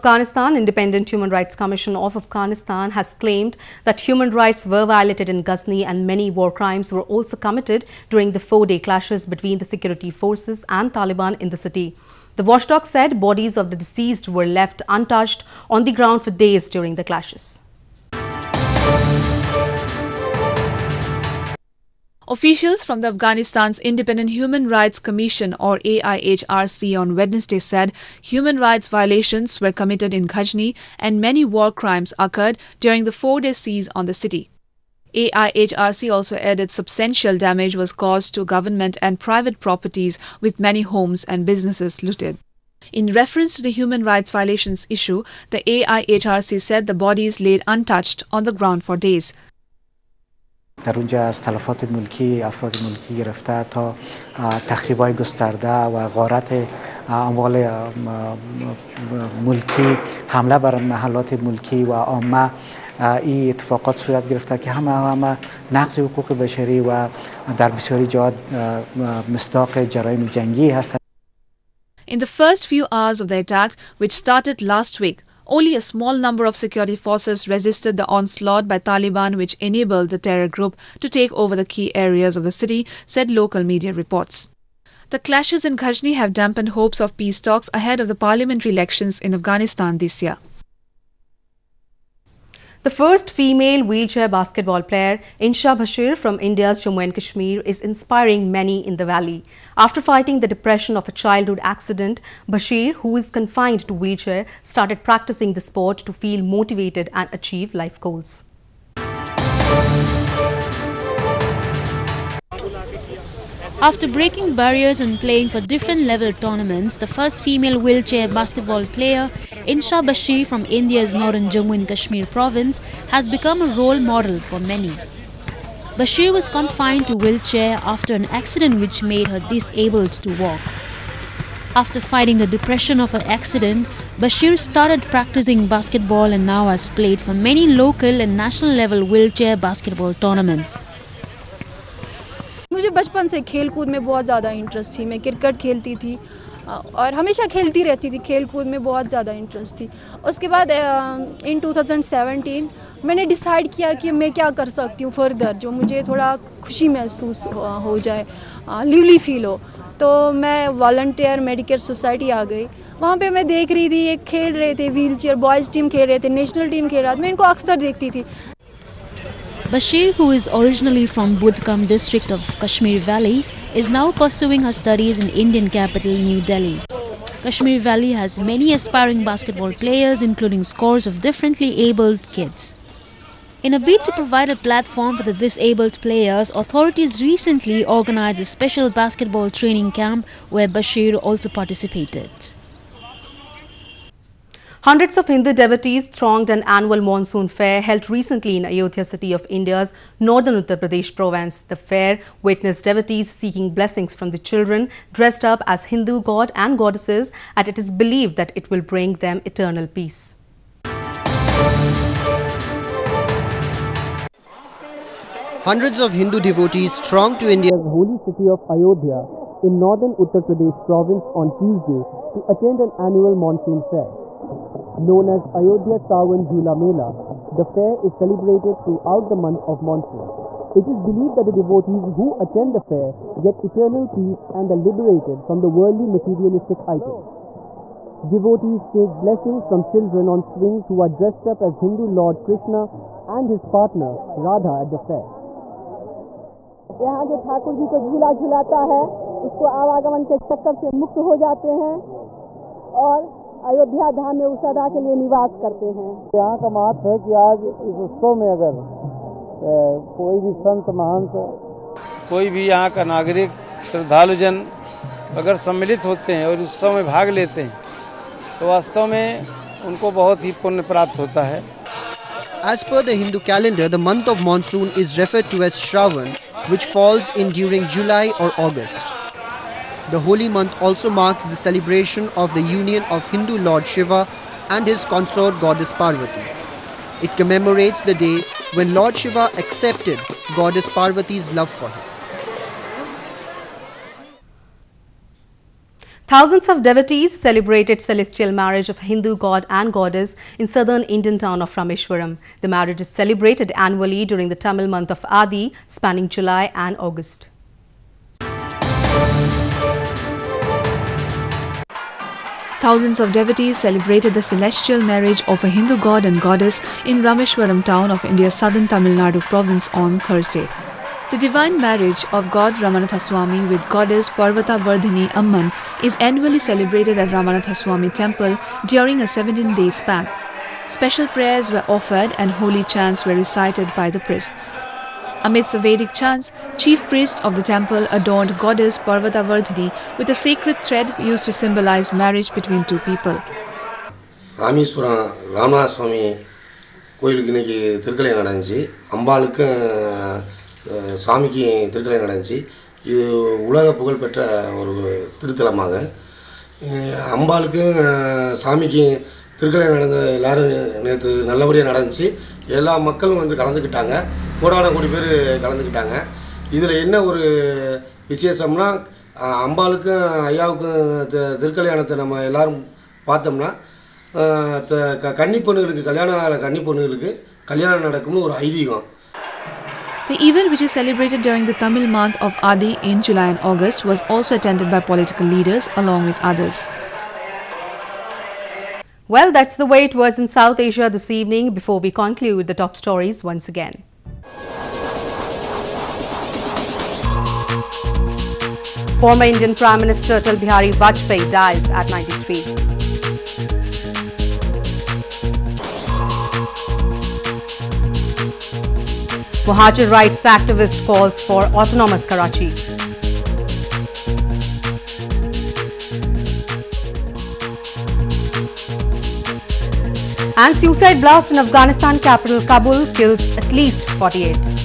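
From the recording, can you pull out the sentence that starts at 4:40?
The holy month also marks the celebration of the union of Hindu Lord Shiva and his consort goddess Parvati.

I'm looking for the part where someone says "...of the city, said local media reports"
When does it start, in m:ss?
1:22.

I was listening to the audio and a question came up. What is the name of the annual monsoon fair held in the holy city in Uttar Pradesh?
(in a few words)
Ayodhya Sawan Jhula Mela.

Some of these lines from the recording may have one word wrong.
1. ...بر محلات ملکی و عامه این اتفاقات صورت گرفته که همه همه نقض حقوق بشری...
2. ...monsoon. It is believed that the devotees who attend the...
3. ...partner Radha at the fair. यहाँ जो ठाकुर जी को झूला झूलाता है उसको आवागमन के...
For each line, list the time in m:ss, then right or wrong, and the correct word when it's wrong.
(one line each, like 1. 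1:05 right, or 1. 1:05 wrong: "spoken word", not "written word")
1. 1:00 right
2. 3:49 right
3. 4:03 right.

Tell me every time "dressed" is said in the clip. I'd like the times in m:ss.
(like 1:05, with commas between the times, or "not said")
3:25, 4:01.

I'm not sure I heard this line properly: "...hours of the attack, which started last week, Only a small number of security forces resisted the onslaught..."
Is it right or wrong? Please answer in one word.
right.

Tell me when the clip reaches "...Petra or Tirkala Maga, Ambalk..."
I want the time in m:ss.
5:54.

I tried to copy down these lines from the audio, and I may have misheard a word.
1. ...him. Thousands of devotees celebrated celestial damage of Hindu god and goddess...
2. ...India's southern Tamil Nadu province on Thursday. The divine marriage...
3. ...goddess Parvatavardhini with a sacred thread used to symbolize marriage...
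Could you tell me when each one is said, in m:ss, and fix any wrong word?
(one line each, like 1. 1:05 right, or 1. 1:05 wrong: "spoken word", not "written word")
1. 4:51 wrong: "marriage", not "damage"
2. 5:18 right
3. 5:38 right.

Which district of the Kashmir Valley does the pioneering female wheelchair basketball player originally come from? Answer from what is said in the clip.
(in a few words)
Budgam.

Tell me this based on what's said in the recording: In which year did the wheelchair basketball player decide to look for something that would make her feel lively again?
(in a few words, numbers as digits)
2017.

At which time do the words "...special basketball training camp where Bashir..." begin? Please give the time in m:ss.
3:08.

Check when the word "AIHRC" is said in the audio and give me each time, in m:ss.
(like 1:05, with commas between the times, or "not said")
0:25, 0:35, 0:45.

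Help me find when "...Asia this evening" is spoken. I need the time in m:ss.
6:30.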